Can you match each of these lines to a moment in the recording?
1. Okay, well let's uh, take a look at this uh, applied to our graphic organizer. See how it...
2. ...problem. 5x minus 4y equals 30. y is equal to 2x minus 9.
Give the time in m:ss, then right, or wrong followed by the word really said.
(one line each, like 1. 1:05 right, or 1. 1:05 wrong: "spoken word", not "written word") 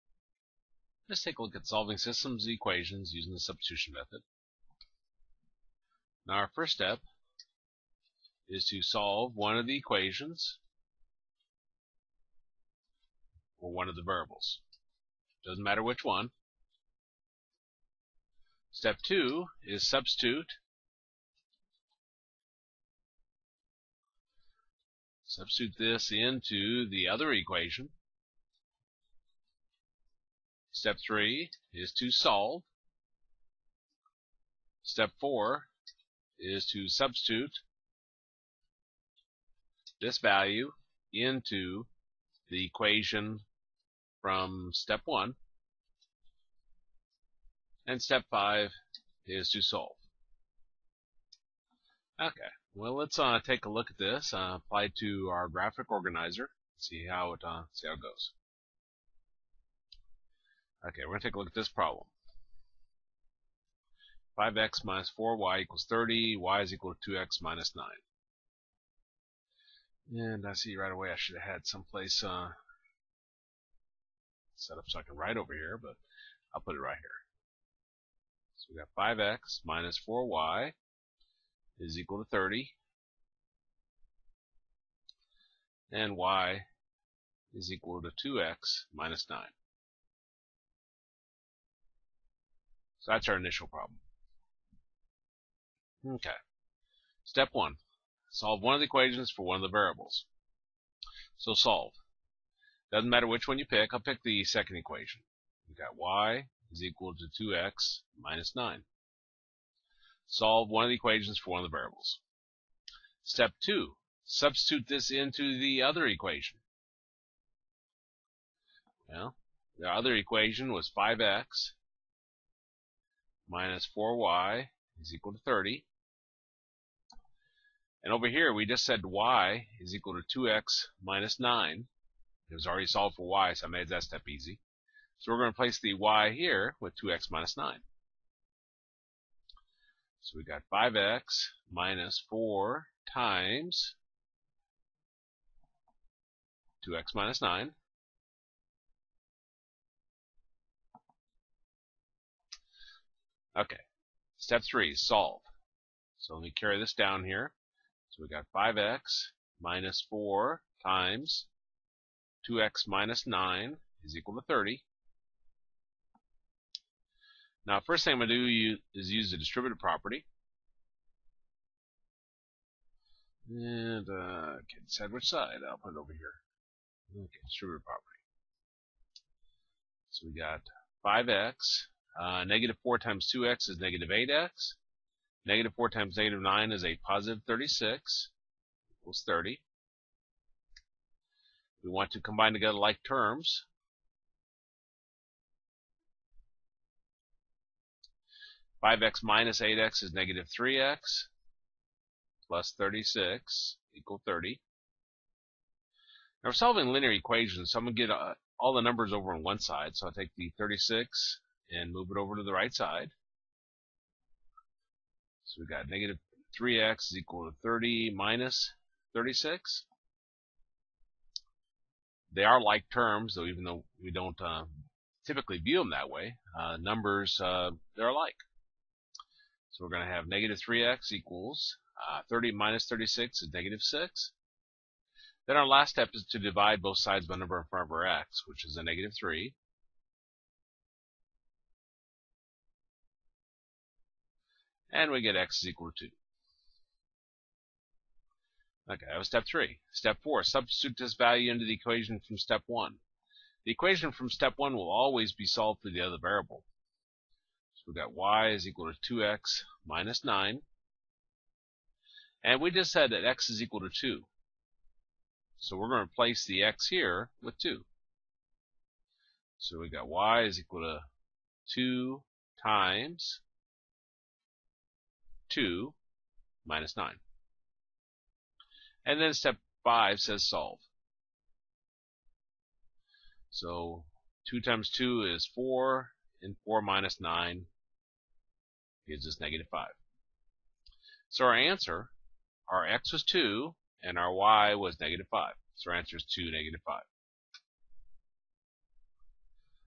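1. 0:52 right
2. 1:01 right.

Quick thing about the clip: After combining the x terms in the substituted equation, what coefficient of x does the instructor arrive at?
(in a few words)
-3x.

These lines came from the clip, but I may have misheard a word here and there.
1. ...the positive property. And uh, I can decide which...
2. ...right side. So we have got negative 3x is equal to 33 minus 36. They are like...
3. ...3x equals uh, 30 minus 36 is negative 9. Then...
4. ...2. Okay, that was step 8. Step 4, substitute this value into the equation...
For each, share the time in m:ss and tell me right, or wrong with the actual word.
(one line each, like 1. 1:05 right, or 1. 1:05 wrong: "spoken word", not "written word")
1. 2:49 wrong: "distributive", not "positive"
2. 3:32 wrong: "30", not "33"
3. 3:50 wrong: "6", not "9"
4. 4:06 wrong: "3", not "8".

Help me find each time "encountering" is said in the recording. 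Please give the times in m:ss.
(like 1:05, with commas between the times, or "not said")
not said.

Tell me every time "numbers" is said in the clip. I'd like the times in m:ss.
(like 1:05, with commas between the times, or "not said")
3:28, 3:46, 3:57.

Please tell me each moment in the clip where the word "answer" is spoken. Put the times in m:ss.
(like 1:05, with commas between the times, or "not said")
4:51, 4:55.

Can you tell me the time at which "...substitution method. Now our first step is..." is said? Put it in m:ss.
0:03.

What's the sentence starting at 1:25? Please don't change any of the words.
And y is equal to 2x minus 9.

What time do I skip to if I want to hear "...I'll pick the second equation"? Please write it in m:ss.
1:43.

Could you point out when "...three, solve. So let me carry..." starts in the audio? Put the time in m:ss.
2:34.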